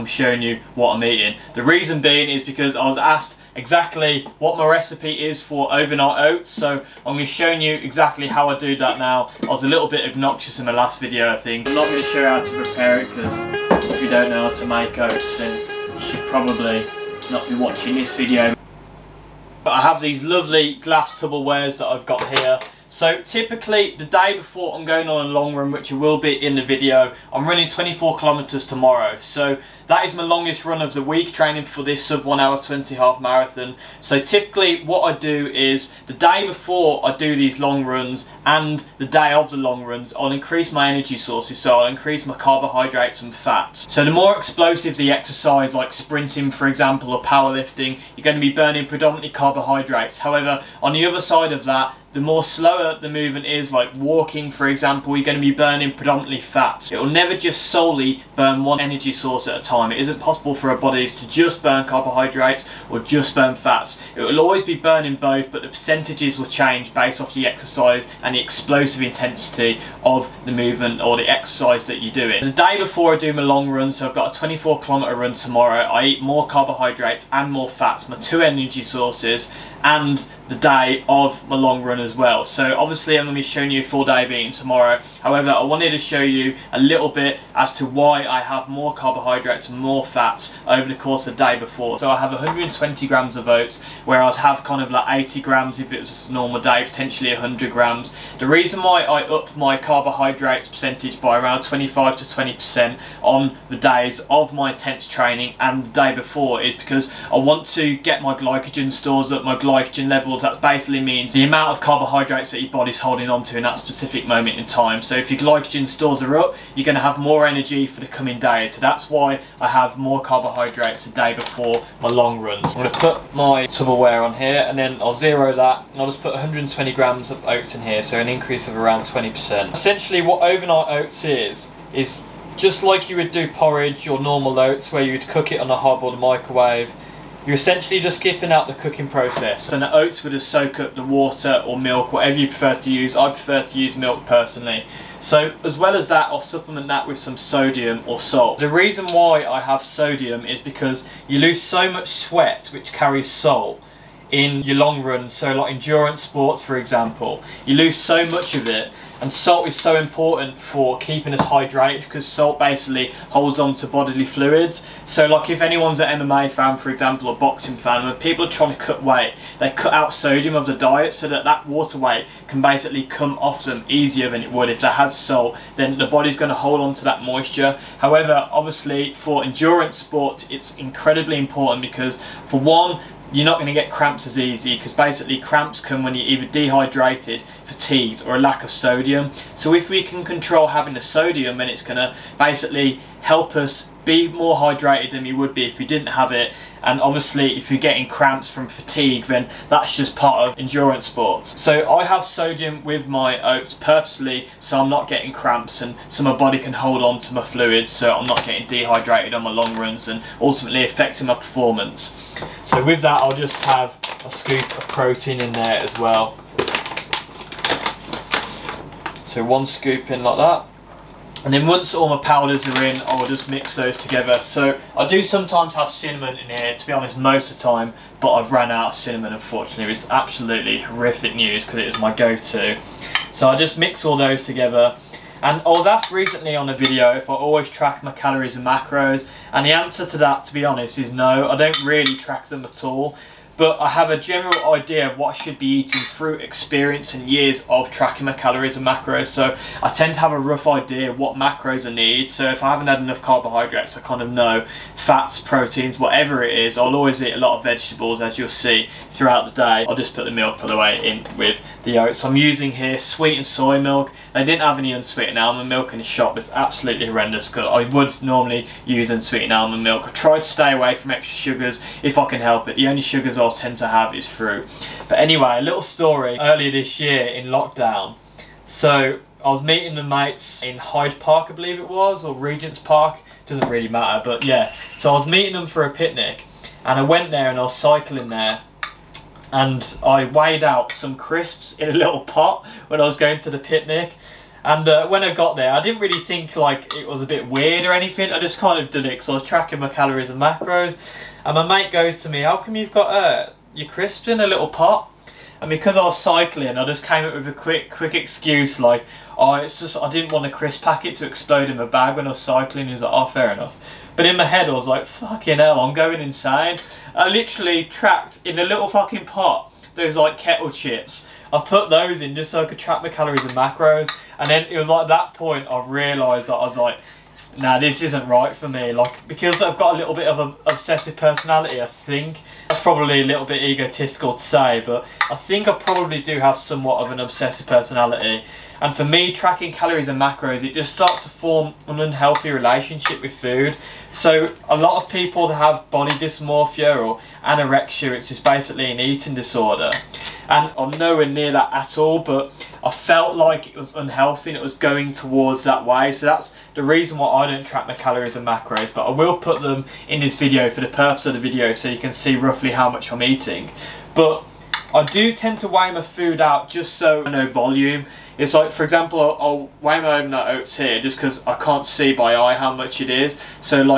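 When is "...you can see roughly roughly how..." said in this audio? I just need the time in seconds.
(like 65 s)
361 s.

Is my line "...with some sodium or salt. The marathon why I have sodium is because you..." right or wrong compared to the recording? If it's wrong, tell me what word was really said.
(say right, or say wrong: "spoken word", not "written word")
wrong: "reason", not "marathon".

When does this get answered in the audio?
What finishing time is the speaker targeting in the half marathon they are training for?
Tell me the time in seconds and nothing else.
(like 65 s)
32 s.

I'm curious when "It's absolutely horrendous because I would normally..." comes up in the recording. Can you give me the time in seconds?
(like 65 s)
266 s.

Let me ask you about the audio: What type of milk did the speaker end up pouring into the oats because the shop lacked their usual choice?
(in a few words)
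sweetened soy milk.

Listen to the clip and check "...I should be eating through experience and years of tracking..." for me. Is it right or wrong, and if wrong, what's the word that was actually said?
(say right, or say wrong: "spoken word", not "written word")
right.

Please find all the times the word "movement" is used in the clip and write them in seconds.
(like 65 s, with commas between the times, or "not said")
53 s, 70 s.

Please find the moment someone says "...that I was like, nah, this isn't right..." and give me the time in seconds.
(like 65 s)
326 s.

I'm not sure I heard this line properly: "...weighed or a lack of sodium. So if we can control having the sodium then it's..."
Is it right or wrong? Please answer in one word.
wrong.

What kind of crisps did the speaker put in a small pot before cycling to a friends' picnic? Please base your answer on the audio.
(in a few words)
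kettle chips.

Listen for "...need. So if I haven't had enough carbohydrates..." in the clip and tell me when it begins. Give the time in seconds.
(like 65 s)
251 s.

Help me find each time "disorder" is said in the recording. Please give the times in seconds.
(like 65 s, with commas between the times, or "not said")
349 s.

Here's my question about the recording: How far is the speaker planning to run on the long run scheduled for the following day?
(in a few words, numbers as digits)
24 kilometers.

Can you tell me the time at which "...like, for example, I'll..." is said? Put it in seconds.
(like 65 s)
368 s.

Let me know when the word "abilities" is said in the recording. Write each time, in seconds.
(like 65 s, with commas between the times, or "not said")
not said.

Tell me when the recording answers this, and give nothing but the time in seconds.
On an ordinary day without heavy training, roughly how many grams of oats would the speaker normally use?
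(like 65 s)
95 s.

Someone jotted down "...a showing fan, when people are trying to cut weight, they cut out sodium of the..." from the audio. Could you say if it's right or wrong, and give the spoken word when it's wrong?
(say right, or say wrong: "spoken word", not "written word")
wrong: "boxing", not "showing".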